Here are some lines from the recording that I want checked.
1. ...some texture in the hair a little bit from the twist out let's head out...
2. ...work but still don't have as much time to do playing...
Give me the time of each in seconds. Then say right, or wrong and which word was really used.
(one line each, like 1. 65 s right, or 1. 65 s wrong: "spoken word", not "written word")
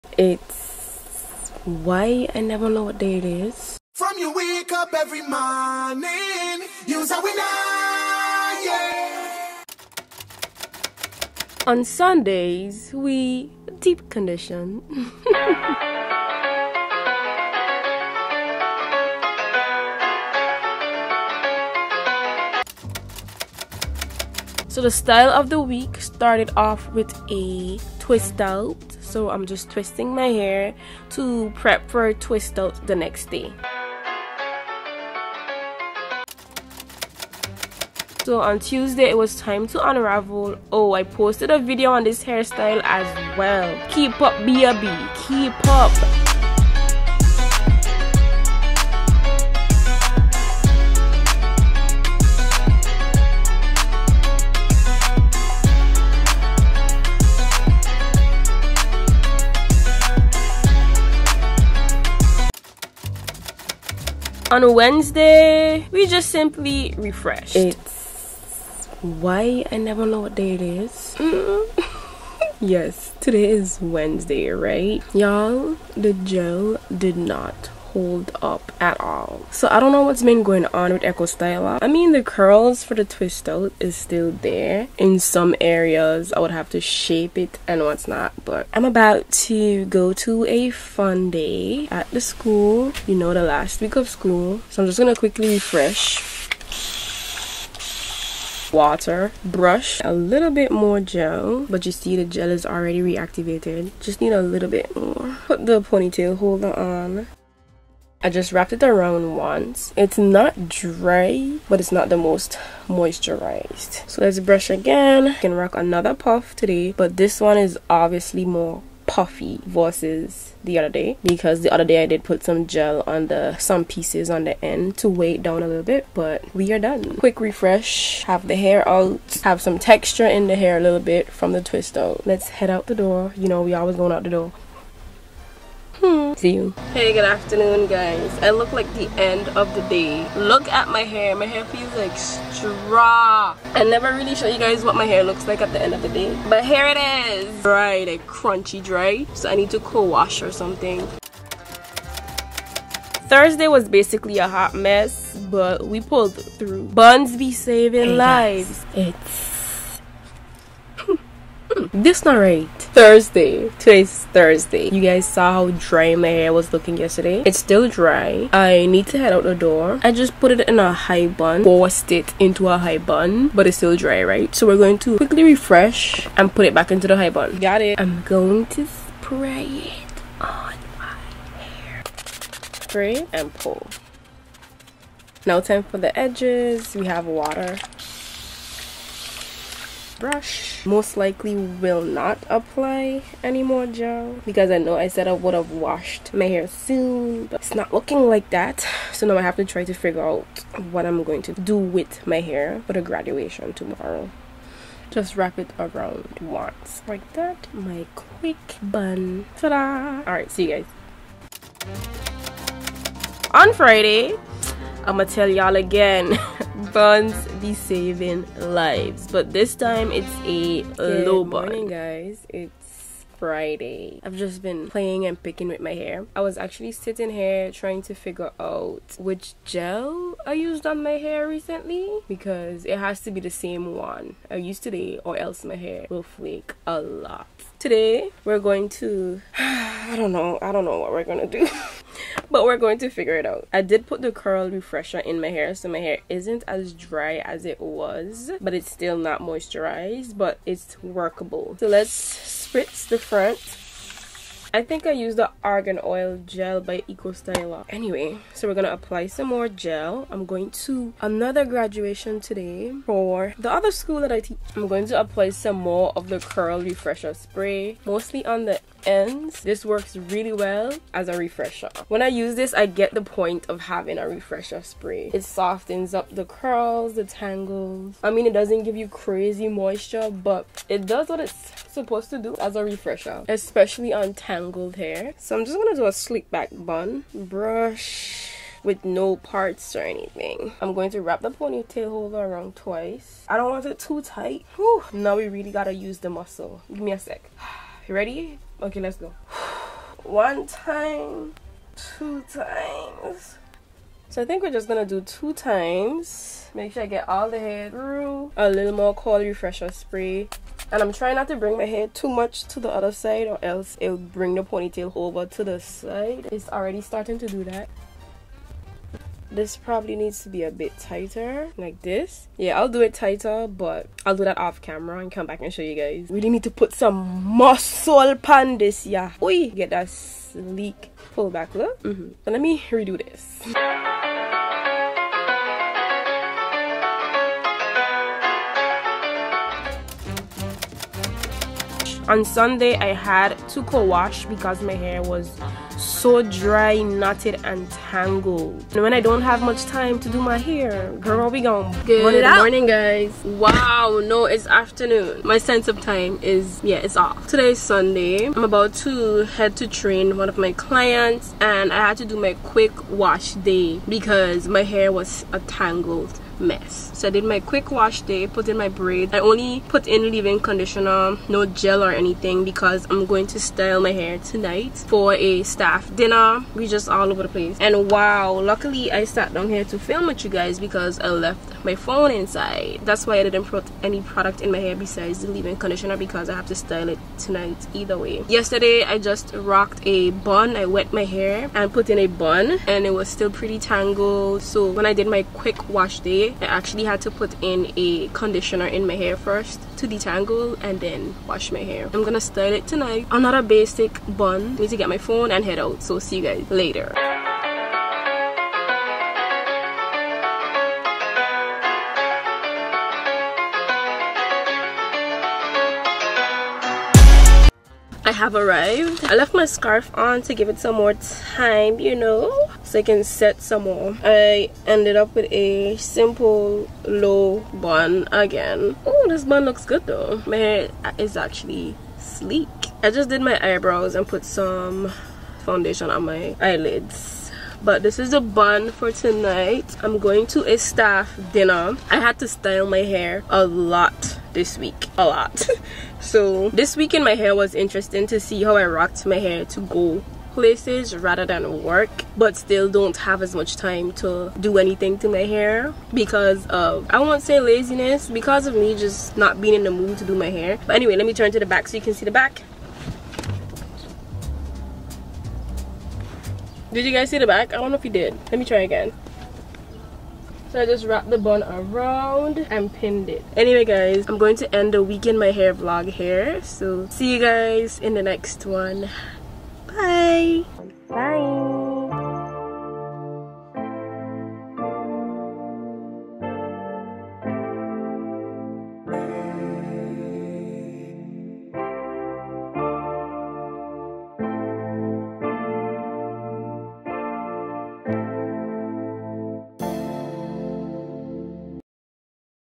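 1. 129 s right
2. 451 s wrong: "anything", not "playing".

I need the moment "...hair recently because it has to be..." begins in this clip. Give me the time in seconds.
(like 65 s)
231 s.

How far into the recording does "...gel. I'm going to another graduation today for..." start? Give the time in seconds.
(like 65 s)
259 s.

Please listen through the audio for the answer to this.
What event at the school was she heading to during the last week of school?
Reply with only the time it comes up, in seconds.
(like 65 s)
90 s.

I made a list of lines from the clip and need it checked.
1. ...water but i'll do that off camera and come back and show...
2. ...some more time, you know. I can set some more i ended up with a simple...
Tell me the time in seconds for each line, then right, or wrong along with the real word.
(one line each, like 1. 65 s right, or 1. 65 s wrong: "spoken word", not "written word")
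1. 323 s wrong: "tighter", not "water"
2. 420 s right.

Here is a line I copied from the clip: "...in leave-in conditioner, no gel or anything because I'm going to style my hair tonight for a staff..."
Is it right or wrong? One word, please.
right.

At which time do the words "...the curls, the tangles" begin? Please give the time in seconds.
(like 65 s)
276 s.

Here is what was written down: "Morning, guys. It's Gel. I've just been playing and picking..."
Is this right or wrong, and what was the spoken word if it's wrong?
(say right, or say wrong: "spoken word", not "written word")
wrong: "Friday", not "Gel".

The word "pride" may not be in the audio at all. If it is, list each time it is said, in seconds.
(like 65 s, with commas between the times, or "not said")
not said.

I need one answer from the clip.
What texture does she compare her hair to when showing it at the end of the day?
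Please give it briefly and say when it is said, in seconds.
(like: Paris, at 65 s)
Straw, at 142 s.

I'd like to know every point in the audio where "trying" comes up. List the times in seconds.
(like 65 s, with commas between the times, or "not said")
227 s, 311 s.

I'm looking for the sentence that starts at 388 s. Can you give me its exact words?
Yesterday I just rocked a bun.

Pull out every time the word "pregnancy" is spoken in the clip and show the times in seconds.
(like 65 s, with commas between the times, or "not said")
not said.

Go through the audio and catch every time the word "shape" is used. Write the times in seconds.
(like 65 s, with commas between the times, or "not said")
86 s.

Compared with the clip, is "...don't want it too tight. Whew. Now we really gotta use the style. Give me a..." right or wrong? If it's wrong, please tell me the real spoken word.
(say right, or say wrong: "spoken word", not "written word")
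wrong: "muscle", not "style".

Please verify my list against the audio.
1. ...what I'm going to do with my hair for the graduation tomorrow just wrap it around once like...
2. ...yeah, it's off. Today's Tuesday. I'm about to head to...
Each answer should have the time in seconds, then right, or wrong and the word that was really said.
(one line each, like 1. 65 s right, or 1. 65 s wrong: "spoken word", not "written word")
1. 200 s right
2. 356 s wrong: "Sunday", not "Tuesday".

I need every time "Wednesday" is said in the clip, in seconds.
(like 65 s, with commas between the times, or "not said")
64 s, 73 s.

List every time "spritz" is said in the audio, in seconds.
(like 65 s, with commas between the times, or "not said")
252 s.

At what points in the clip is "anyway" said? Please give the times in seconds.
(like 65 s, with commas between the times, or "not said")
257 s, 460 s, 473 s.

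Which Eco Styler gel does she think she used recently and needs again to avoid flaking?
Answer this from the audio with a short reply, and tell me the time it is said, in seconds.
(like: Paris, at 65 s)
Argan Oil Gel, at 255 s.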